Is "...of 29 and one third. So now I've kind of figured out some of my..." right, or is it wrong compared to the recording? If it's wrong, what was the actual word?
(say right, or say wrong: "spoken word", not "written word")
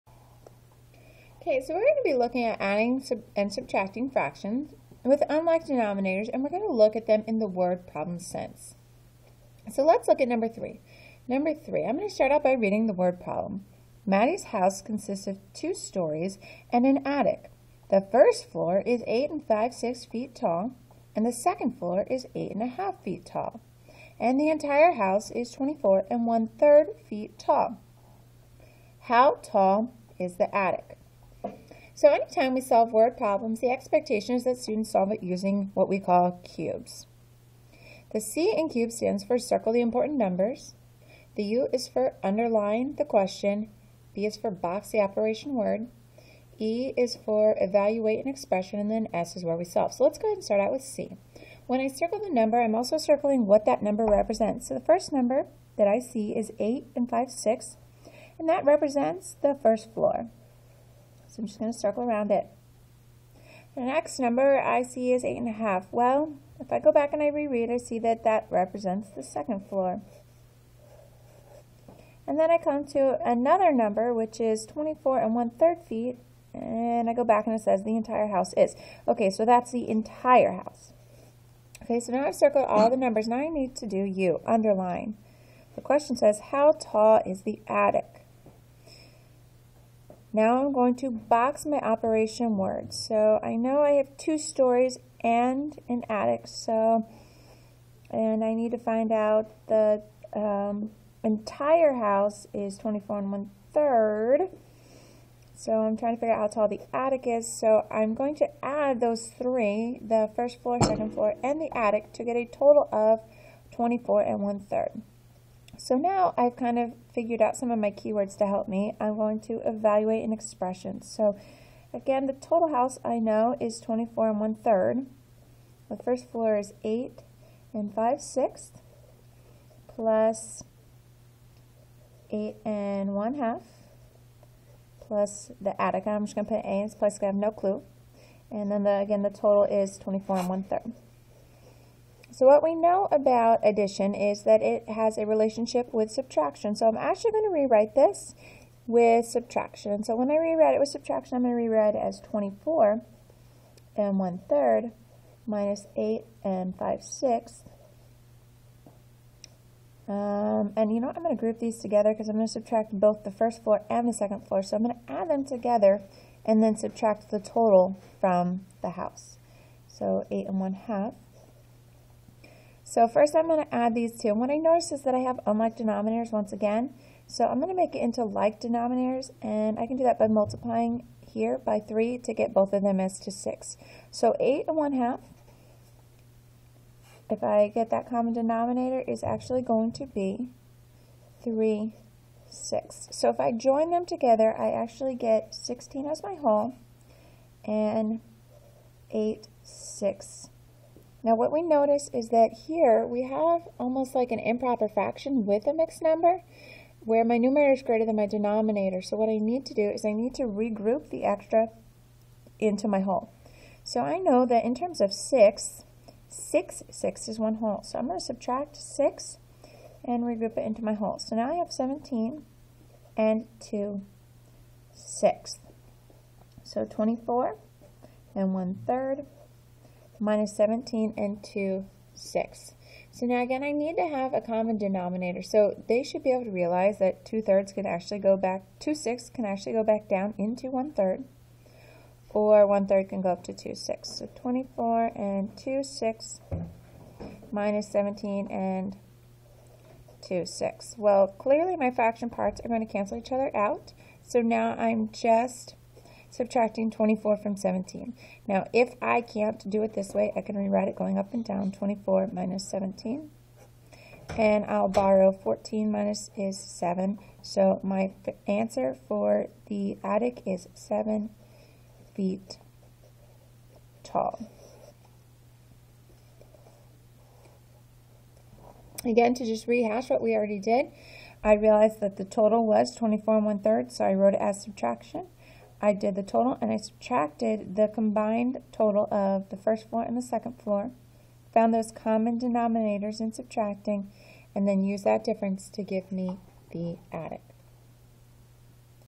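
wrong: "24", not "29".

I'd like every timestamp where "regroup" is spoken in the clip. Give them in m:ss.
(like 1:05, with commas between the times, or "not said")
3:30, 3:40.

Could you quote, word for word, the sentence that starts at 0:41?
The U is for underline the question.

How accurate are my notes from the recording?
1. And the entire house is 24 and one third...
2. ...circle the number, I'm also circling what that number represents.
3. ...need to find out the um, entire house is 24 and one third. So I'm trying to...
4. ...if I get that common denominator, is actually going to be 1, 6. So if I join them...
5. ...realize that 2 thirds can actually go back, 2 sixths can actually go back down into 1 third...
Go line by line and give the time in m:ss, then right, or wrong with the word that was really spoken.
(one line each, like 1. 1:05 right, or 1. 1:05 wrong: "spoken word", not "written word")
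1. 0:24 right
2. 0:51 right
3. 1:38 right
4. 3:07 wrong: "3", not "1"
5. 3:56 right.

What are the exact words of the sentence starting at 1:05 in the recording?
Well, if I go back and I reread, I see that that represents the second floor.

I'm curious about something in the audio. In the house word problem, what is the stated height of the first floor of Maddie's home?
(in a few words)
8 5/6 feet.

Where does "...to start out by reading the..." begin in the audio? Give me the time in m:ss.
0:12.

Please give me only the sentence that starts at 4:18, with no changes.
Now, if I can't do it this way, I can rewrite it going up and down, 24 minus 17.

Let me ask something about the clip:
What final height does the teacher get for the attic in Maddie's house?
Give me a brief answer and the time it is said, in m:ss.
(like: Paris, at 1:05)
7 feet, at 4:30.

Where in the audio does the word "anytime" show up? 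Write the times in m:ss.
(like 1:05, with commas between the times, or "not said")
0:32.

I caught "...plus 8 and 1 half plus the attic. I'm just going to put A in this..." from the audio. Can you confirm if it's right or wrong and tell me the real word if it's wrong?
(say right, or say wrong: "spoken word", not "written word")
right.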